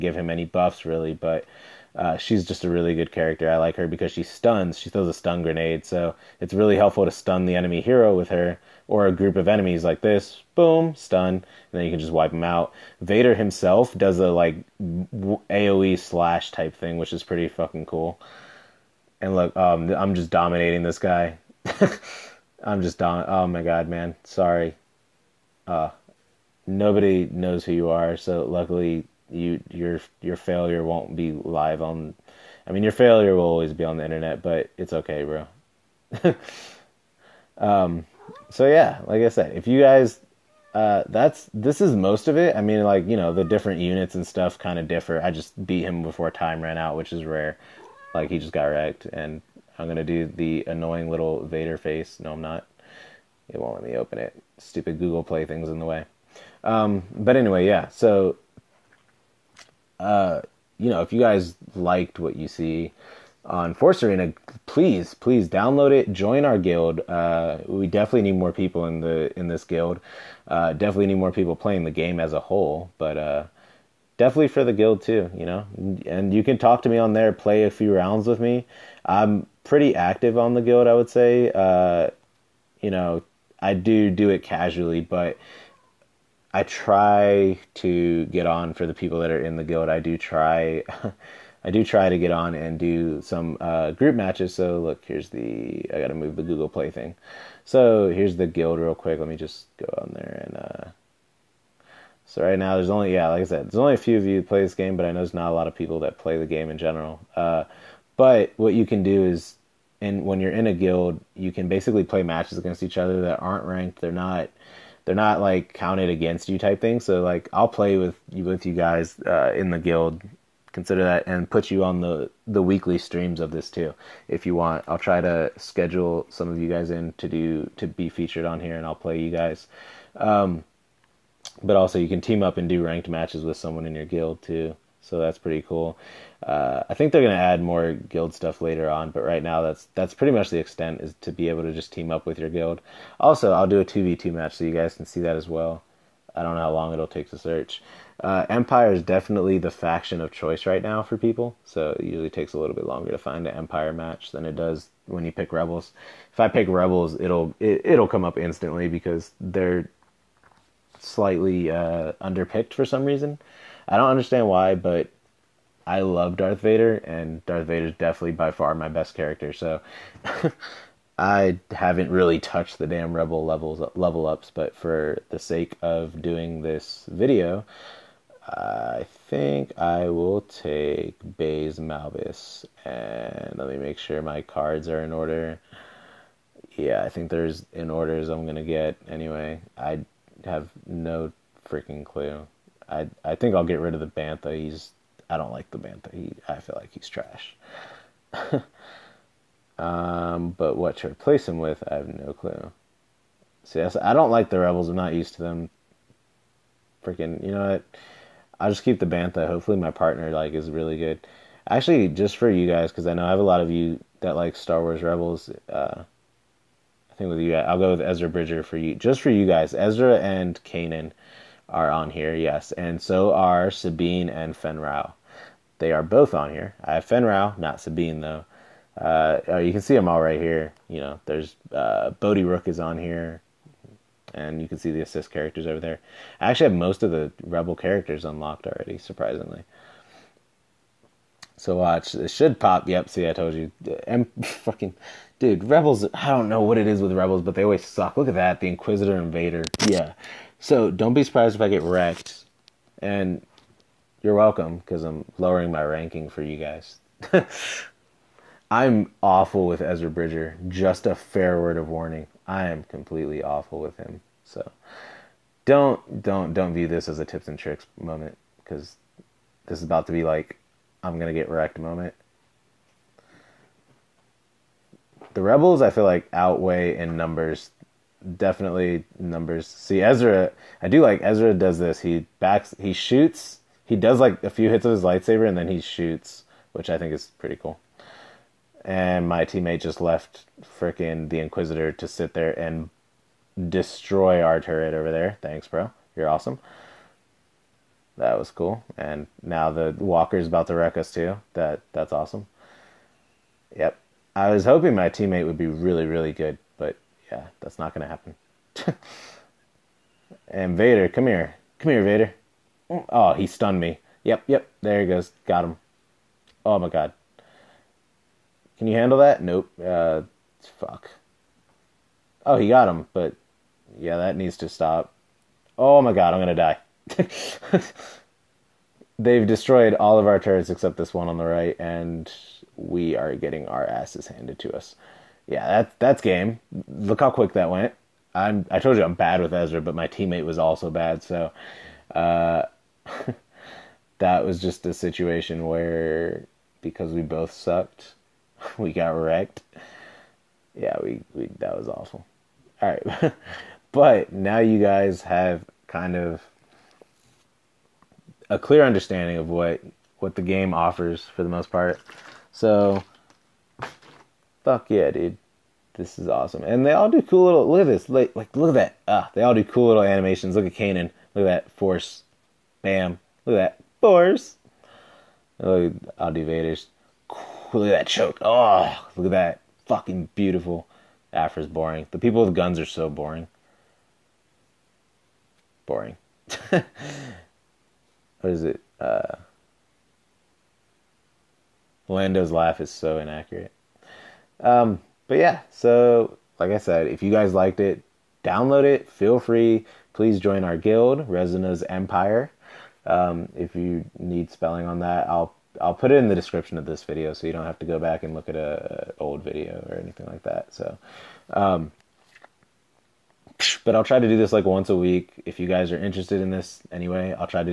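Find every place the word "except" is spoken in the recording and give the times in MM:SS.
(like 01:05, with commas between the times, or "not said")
05:30.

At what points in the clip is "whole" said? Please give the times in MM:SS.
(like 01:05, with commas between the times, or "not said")
01:12.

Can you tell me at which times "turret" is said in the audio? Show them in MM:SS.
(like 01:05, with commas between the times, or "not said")
04:54, 05:30.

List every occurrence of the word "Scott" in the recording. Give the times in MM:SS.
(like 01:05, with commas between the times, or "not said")
not said.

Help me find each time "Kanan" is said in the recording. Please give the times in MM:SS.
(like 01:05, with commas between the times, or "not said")
03:40, 06:10.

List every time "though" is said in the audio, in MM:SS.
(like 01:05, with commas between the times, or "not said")
03:48.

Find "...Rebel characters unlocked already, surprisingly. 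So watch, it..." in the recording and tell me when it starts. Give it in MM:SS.
03:57.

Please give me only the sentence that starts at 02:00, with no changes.
Consider that and put you on the the weekly streams of this too, if you want.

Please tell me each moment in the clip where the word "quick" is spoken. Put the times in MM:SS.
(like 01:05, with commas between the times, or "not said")
01:38, 05:37.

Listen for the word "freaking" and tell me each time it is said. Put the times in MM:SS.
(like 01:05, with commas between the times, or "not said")
03:11, 03:27, 04:50.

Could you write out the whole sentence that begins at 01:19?
I'm pretty active on the guild, I would say.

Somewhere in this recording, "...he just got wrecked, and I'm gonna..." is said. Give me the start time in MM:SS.
00:48.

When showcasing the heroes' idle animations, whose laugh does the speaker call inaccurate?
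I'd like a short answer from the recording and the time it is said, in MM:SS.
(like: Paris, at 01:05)
Lando, at 06:32.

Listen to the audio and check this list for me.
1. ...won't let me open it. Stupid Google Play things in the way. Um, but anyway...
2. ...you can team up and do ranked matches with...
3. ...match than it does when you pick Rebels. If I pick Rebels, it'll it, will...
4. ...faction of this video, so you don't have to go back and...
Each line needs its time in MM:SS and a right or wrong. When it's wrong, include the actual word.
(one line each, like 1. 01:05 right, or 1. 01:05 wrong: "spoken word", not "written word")
1. 00:53 right
2. 02:11 right
3. 02:33 right
4. 06:46 wrong: "description", not "faction".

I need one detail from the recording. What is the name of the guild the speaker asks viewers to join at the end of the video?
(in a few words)
Resona's Empire.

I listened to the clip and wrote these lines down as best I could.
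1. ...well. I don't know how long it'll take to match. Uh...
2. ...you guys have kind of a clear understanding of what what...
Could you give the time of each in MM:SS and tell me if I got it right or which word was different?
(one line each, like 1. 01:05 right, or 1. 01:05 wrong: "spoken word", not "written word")
1. 02:25 wrong: "search", not "match"
2. 05:54 right.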